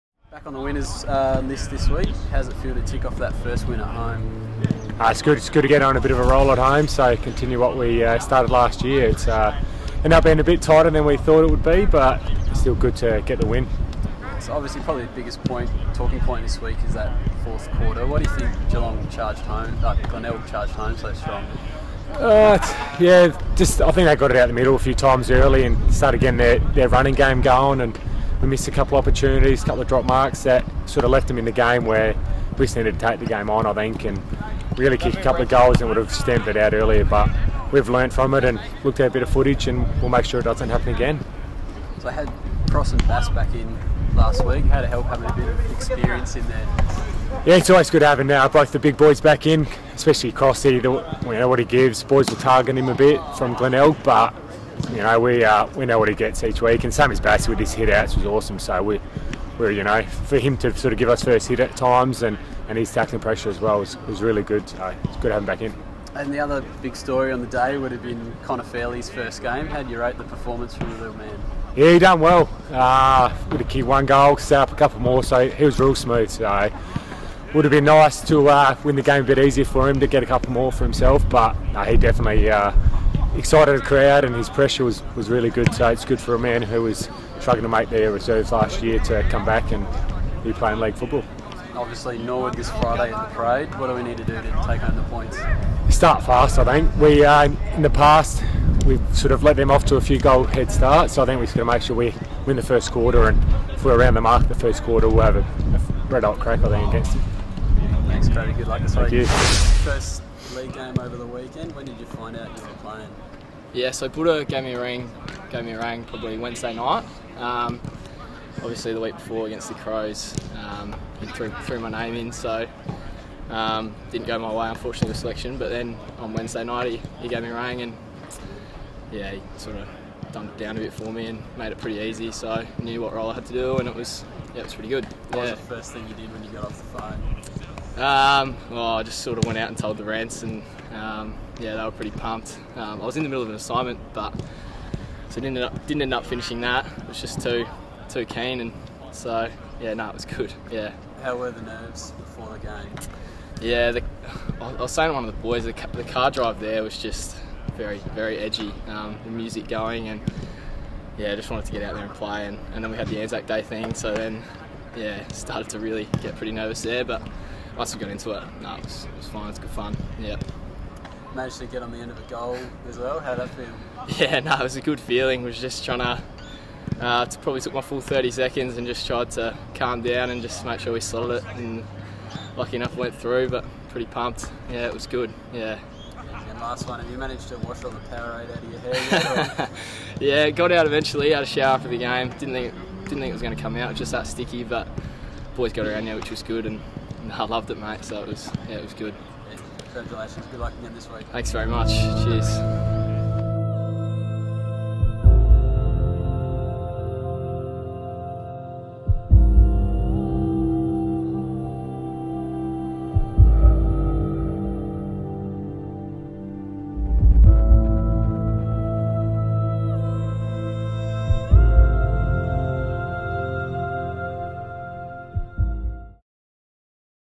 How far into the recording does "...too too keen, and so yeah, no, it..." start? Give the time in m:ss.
2:27.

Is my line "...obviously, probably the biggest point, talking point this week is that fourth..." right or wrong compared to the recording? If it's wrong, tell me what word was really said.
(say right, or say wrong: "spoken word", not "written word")
right.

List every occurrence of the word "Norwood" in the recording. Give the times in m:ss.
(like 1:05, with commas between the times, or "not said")
1:32.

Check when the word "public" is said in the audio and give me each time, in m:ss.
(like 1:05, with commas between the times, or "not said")
not said.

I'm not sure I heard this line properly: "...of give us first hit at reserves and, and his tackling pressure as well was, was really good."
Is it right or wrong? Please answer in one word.
wrong.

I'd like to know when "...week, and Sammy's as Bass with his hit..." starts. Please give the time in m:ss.
0:56.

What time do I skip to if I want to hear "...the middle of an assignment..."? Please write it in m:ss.
2:23.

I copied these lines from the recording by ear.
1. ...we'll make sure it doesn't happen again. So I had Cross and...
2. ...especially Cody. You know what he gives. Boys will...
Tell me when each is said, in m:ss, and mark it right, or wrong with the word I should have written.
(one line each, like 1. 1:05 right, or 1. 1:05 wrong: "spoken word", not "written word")
1. 0:40 right
2. 0:49 wrong: "Crossy", not "Cody".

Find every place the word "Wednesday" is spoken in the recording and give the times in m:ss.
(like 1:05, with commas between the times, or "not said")
1:56, 2:06.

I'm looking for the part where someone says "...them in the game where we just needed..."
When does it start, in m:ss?
0:31.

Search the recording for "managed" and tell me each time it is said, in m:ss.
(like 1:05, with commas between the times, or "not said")
2:51, 3:07.